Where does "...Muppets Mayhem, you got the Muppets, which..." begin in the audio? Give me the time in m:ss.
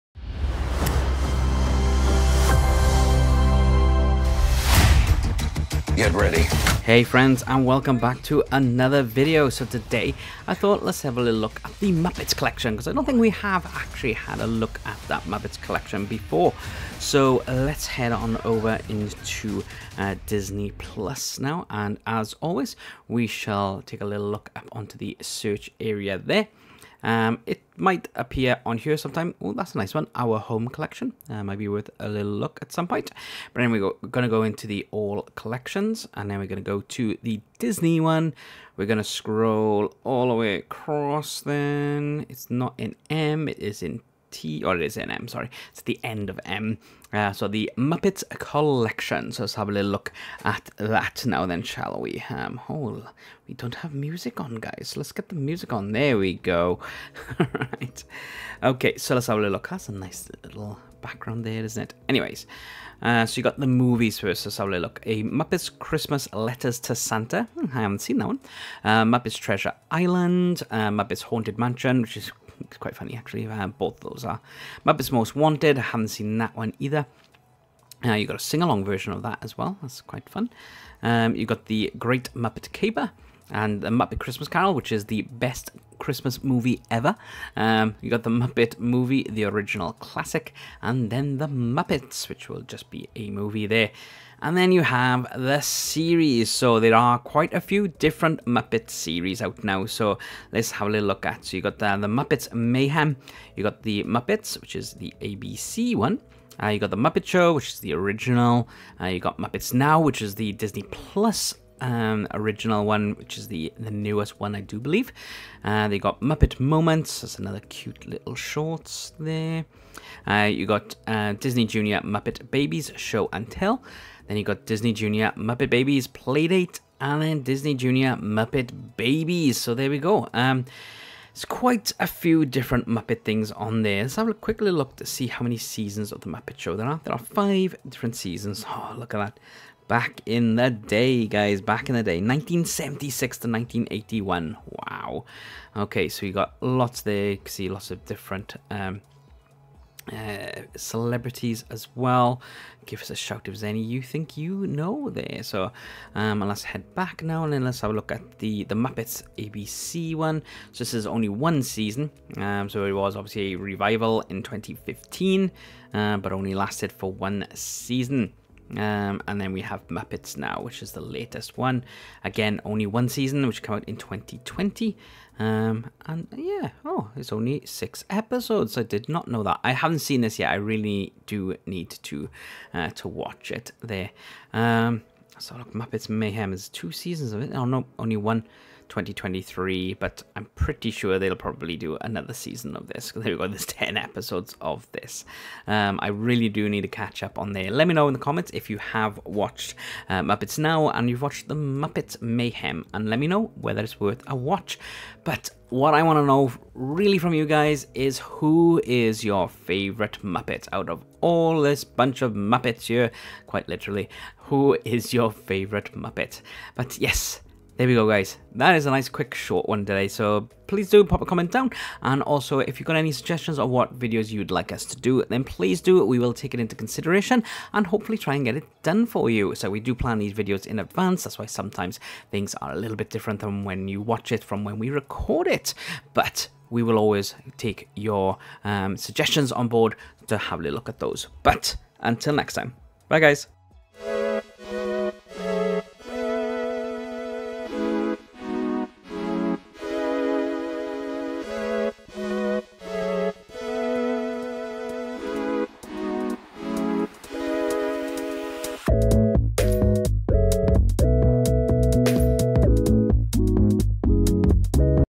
1:42.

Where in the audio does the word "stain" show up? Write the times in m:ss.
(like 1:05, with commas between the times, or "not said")
not said.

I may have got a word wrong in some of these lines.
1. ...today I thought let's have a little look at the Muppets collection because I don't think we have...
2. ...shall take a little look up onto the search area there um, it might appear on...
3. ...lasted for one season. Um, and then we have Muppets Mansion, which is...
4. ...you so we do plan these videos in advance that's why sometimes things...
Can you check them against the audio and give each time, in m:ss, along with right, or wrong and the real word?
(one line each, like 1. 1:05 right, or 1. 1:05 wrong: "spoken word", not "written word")
1. 0:09 right
2. 0:23 right
3. 2:46 wrong: "Now", not "Mansion"
4. 3:49 right.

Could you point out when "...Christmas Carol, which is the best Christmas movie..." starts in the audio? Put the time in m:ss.
1:24.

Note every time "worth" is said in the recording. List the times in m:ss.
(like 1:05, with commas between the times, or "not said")
0:31, 3:24.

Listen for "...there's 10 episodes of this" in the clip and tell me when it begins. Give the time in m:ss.
3:13.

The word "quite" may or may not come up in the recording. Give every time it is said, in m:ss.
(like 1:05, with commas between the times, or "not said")
1:12, 1:20, 1:37, 2:11, 3:33.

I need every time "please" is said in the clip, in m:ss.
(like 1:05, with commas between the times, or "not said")
3:40, 3:45.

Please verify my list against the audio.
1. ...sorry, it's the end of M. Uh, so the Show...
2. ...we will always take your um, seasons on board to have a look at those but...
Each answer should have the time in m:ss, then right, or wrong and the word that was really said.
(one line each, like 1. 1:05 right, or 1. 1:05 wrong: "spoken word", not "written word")
1. 0:45 wrong: "Muppets", not "Show"
2. 3:56 wrong: "suggestions", not "seasons".